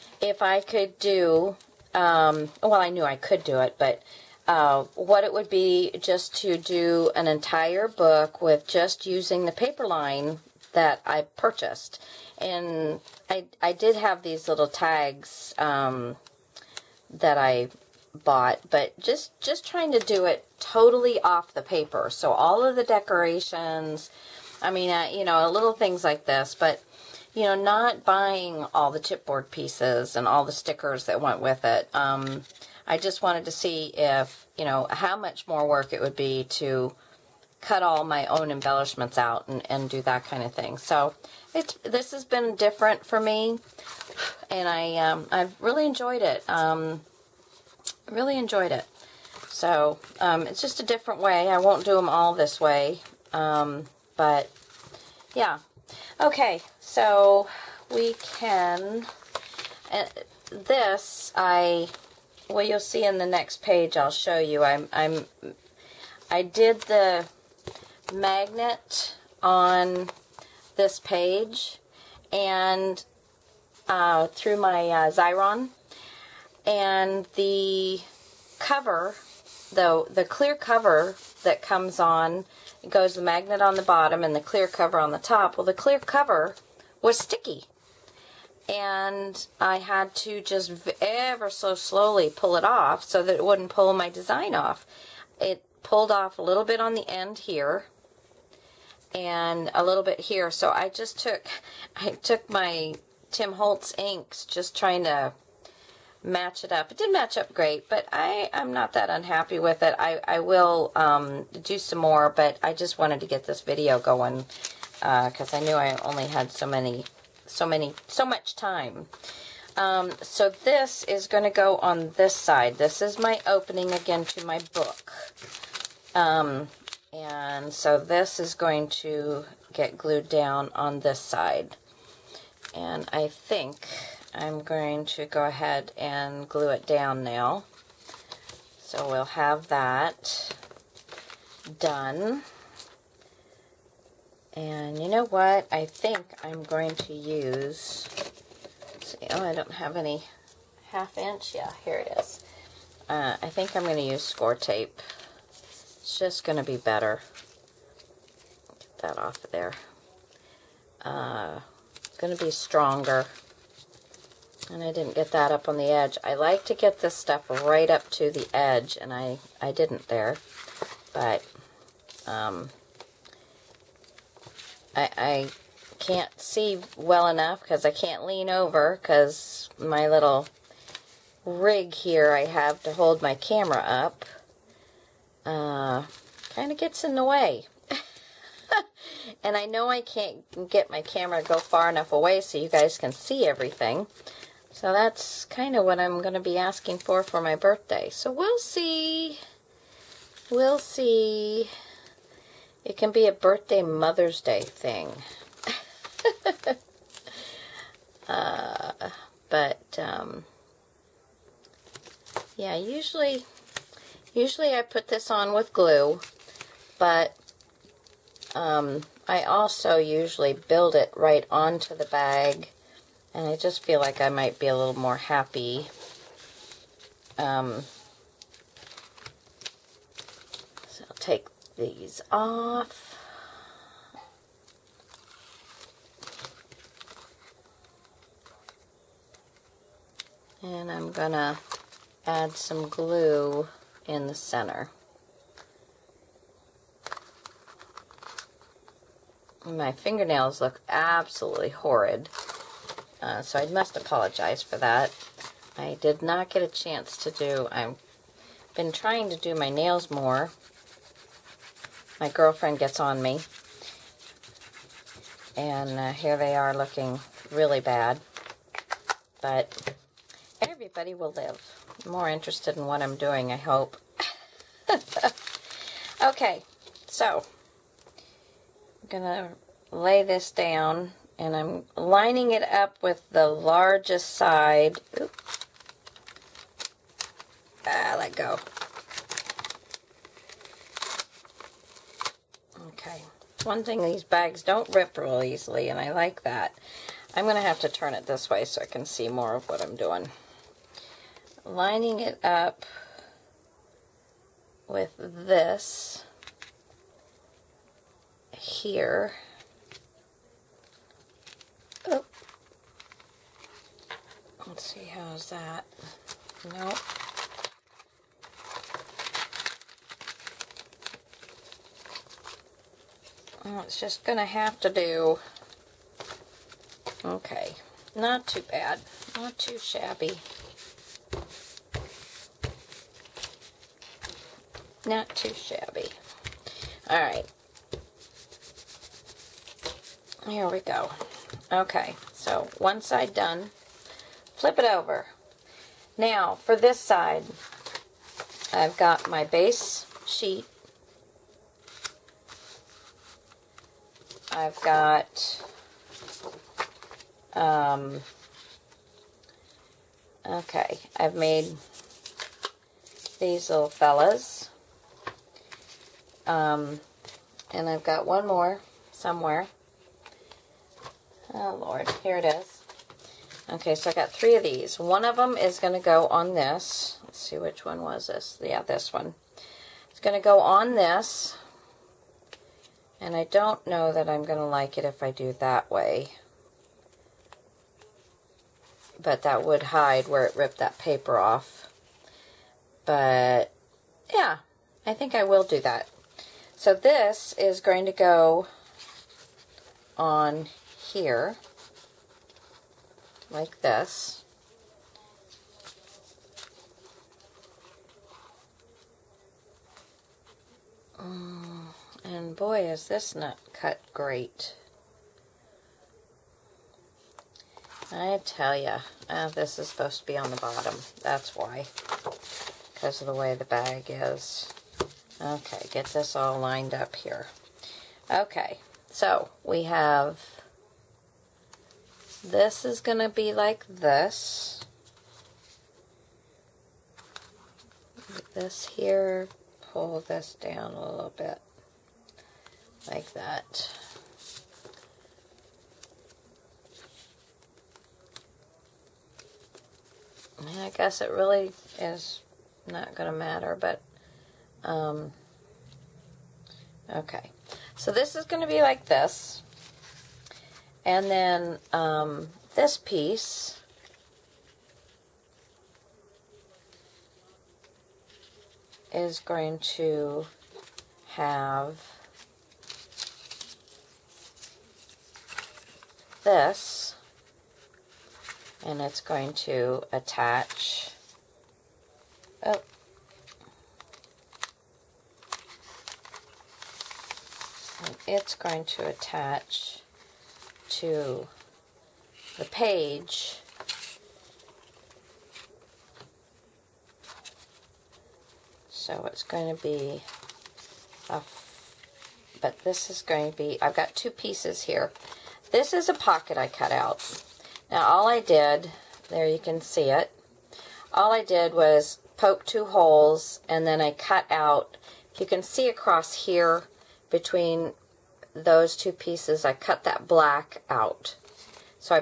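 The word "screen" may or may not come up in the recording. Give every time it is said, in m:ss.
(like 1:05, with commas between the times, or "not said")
not said.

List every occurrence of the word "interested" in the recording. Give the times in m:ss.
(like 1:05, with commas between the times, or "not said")
4:32.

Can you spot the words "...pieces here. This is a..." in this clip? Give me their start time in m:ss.
8:24.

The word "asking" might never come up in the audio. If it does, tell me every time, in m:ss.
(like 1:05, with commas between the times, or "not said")
3:16.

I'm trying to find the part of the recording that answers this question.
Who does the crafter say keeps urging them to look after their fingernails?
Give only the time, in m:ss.
4:22.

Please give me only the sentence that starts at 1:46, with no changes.
It did match up great, but I, I'm not that unhappy with it.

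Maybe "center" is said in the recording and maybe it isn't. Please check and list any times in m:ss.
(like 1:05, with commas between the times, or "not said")
4:04.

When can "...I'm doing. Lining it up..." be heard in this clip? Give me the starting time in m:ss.
4:59.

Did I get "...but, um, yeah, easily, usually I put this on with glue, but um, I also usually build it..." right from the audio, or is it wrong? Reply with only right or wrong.
wrong.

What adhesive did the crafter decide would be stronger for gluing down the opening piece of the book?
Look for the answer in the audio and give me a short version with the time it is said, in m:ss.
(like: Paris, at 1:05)
score tape, at 2:34.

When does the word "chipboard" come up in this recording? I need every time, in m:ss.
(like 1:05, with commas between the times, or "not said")
0:29.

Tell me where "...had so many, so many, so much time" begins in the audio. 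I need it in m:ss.
1:56.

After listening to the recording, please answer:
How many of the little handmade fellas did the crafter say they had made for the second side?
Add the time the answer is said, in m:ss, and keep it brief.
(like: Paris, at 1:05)
3, at 6:14.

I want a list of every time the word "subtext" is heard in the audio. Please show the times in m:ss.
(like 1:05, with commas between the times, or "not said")
not said.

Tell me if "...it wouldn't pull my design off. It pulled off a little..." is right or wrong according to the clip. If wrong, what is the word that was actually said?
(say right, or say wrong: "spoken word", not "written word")
right.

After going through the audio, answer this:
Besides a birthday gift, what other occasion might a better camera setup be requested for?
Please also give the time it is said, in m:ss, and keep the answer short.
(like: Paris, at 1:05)
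Mother's Day, at 3:23.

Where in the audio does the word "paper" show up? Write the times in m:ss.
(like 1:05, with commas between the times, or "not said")
0:09, 0:21, 6:30.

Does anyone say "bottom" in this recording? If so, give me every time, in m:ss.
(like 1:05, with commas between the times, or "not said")
1:23, 7:00.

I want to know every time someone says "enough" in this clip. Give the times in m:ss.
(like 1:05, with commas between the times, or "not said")
2:57, 3:11.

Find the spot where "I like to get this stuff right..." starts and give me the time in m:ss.
2:46.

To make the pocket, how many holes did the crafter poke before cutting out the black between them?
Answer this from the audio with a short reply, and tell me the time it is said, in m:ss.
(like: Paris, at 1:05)
2, at 8:32.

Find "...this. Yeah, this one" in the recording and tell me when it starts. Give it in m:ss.
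6:18.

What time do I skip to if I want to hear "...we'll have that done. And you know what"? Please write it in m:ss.
2:19.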